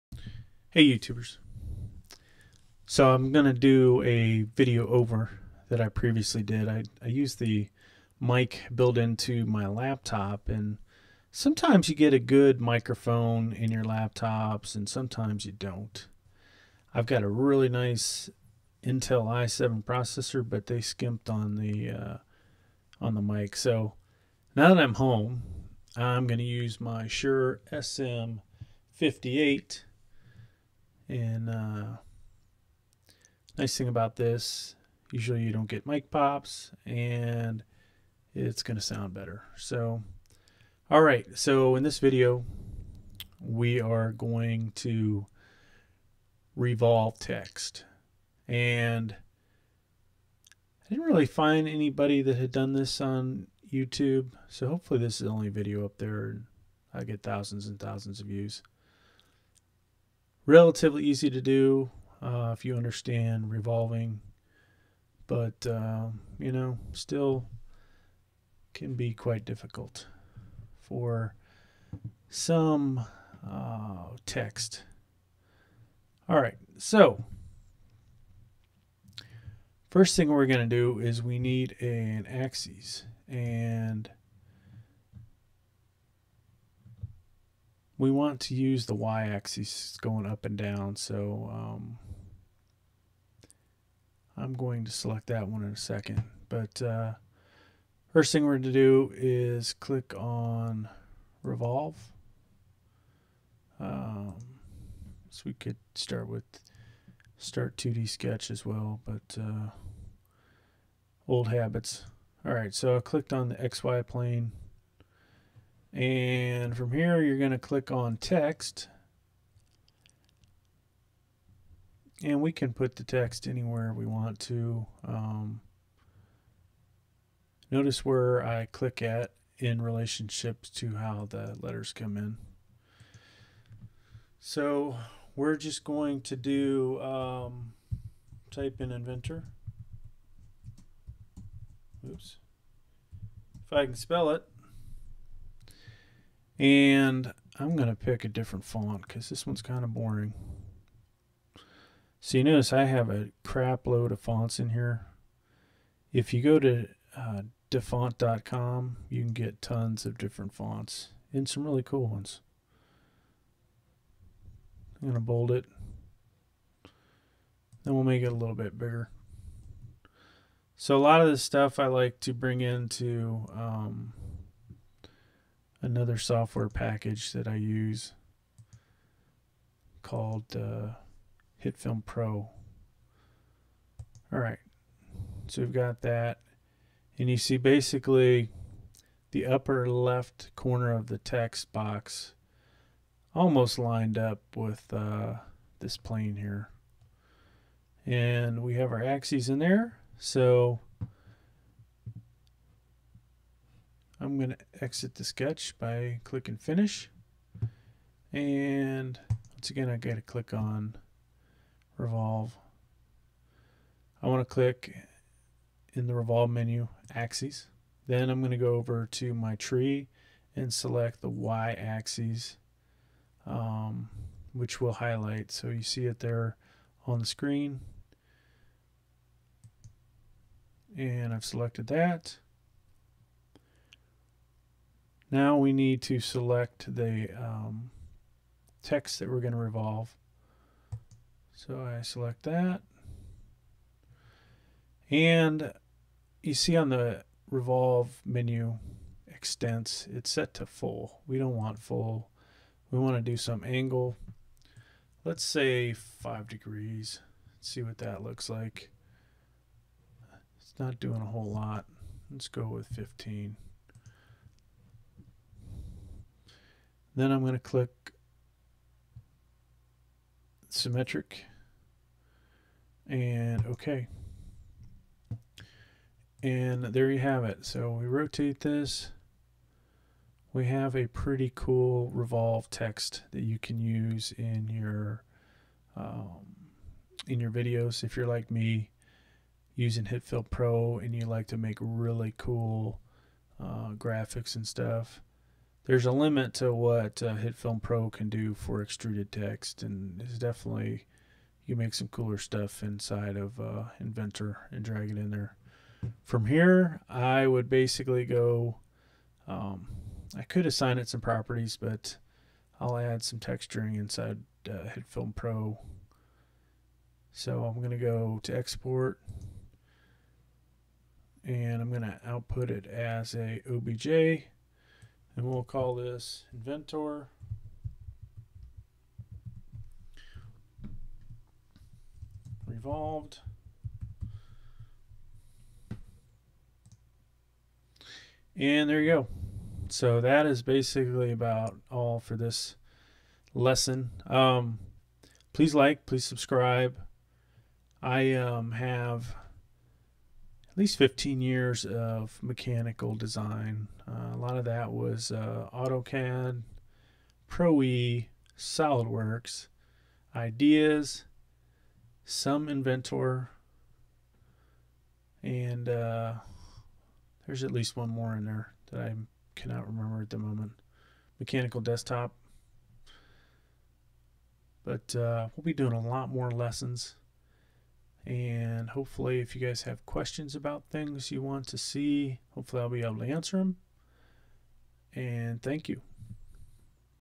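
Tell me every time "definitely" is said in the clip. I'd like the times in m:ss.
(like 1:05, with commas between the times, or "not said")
5:00.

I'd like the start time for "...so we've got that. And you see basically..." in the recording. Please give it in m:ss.
3:05.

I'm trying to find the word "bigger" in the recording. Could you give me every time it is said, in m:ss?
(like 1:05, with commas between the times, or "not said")
2:48.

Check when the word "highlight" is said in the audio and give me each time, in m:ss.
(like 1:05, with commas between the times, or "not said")
3:44.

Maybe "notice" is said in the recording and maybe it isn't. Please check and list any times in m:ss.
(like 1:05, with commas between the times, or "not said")
2:07, 2:32.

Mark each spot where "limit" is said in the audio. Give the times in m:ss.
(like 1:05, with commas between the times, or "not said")
4:56.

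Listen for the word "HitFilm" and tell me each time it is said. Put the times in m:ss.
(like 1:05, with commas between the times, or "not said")
3:01, 4:50, 4:57, 5:14.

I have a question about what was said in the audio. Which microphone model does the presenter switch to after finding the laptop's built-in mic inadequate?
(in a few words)
Shure SM58.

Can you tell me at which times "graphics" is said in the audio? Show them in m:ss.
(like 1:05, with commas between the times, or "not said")
4:53.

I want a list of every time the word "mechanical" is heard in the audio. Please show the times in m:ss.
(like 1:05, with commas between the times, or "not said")
5:52, 6:11.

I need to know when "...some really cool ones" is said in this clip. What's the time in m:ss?
2:41.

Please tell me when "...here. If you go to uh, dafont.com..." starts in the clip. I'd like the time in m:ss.
2:34.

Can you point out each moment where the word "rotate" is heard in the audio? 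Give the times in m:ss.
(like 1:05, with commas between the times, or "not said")
4:38.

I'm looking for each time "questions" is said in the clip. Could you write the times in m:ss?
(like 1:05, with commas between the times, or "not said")
6:20.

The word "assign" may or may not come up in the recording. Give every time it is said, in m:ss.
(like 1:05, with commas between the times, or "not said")
5:10.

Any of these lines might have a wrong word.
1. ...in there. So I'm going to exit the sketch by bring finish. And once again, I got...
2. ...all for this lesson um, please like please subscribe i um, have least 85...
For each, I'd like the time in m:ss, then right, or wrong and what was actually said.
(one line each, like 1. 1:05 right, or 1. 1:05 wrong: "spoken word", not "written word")
1. 3:19 wrong: "clicking", not "bring"
2. 5:41 wrong: "15", not "85".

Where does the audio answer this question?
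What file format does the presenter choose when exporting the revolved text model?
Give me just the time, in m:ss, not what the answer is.
5:23.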